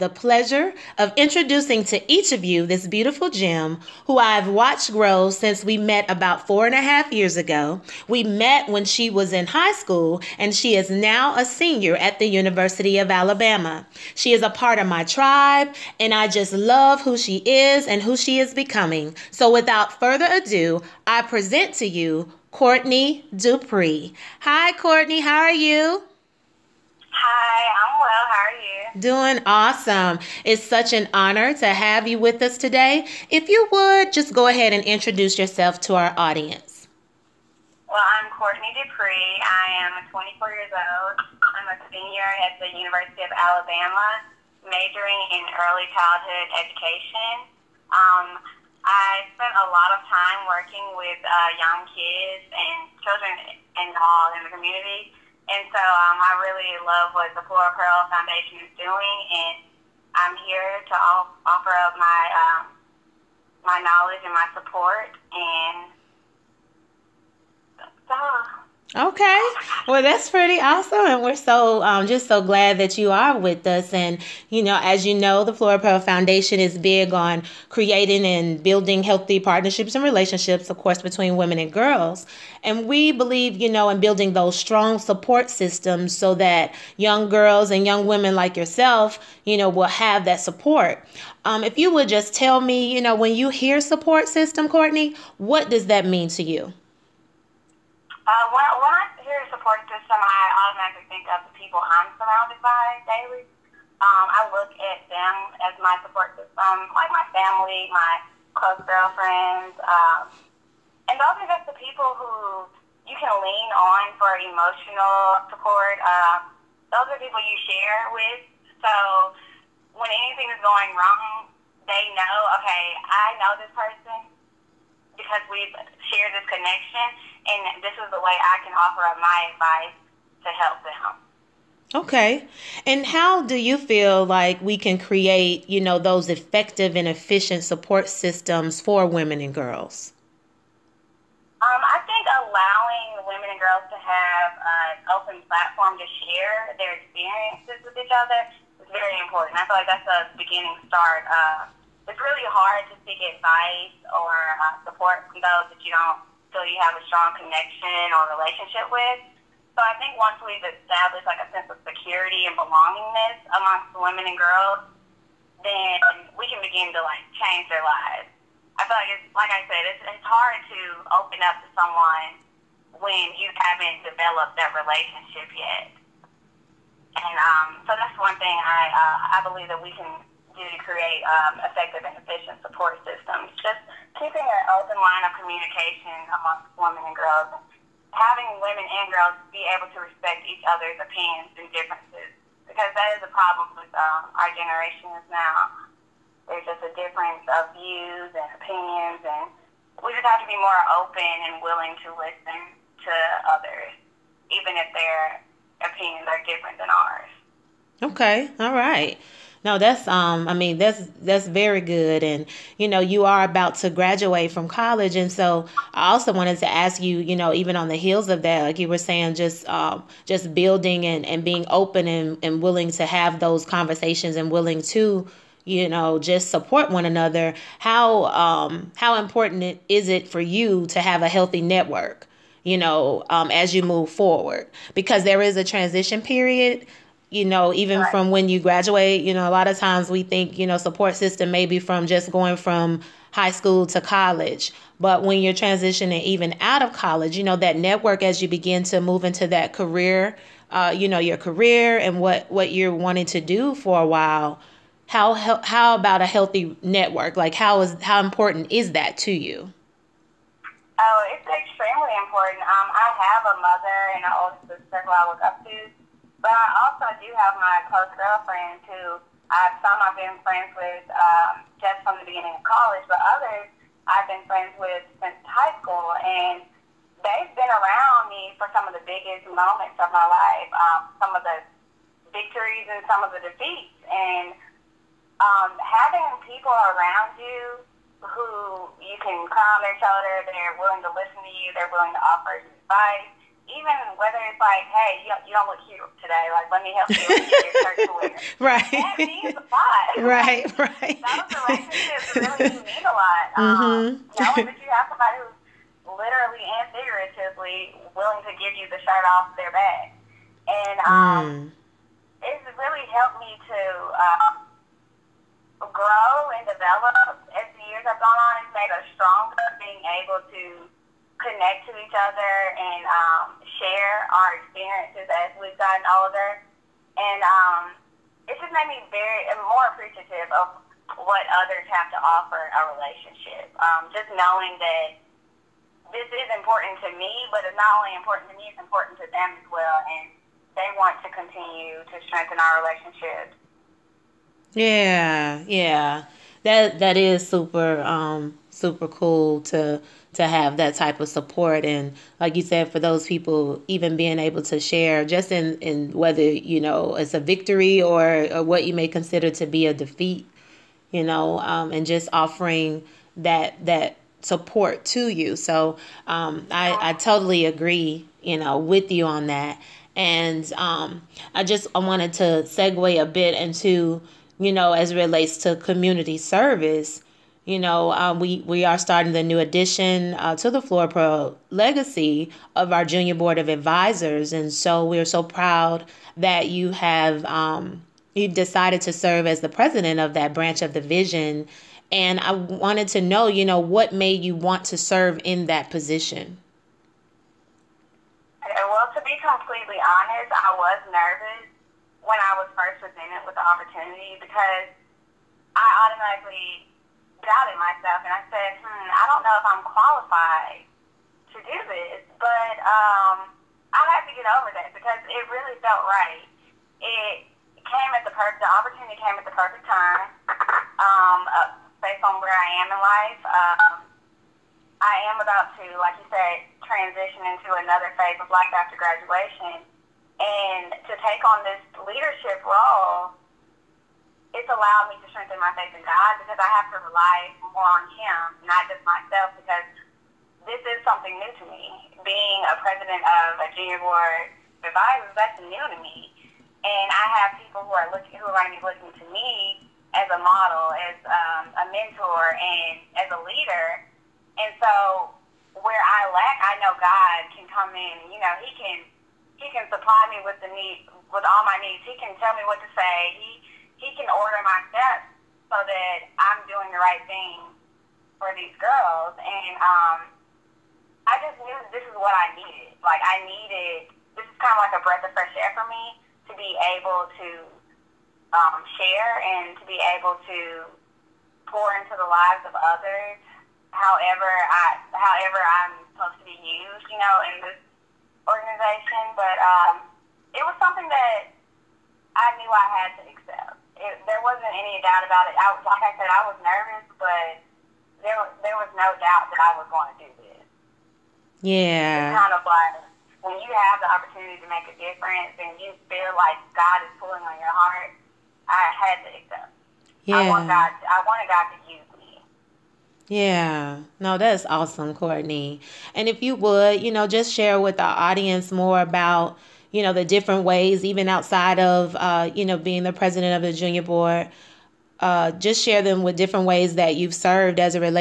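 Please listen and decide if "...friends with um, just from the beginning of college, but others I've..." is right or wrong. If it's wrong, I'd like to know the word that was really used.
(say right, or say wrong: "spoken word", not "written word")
right.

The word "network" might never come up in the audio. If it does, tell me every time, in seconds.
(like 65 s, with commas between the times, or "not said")
231 s, 247 s, 256 s.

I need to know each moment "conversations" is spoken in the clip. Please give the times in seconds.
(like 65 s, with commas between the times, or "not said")
223 s.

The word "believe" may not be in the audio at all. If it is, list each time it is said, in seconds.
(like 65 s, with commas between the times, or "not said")
83 s, 179 s.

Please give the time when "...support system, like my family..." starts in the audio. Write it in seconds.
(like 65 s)
106 s.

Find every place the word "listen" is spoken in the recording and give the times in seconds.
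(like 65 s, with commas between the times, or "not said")
202 s, 291 s.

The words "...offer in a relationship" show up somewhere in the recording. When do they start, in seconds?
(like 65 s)
332 s.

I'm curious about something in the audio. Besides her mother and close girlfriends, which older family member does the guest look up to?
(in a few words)
older sister.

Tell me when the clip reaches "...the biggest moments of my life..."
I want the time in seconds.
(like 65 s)
278 s.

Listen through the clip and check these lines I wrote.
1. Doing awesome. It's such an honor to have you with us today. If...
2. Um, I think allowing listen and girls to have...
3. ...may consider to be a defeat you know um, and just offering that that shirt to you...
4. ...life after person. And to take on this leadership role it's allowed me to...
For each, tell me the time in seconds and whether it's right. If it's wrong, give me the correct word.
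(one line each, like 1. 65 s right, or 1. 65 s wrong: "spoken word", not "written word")
1. 29 s right
2. 141 s wrong: "women", not "listen"
3. 358 s wrong: "support", not "shirt"
4. 428 s wrong: "graduation", not "person".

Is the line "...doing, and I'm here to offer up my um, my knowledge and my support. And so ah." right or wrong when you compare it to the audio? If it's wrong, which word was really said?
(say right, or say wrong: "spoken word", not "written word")
right.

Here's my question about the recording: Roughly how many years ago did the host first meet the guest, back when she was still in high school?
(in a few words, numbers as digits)
four and a half years.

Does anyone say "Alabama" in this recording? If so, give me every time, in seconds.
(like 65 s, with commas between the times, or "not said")
13 s, 43 s.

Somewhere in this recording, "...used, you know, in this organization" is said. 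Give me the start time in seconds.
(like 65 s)
486 s.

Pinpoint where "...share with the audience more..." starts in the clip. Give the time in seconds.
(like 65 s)
517 s.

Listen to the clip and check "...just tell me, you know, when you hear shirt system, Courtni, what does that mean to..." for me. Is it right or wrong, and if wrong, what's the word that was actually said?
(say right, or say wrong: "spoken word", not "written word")
wrong: "support", not "shirt".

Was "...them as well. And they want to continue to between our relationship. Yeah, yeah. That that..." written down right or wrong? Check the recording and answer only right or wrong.
wrong.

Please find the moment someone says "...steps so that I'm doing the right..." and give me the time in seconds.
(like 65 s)
464 s.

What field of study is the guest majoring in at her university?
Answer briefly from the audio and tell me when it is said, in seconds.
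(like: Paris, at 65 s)
early childhood education, at 45 s.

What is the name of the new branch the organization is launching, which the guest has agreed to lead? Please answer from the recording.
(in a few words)
Junior Board of Advisors.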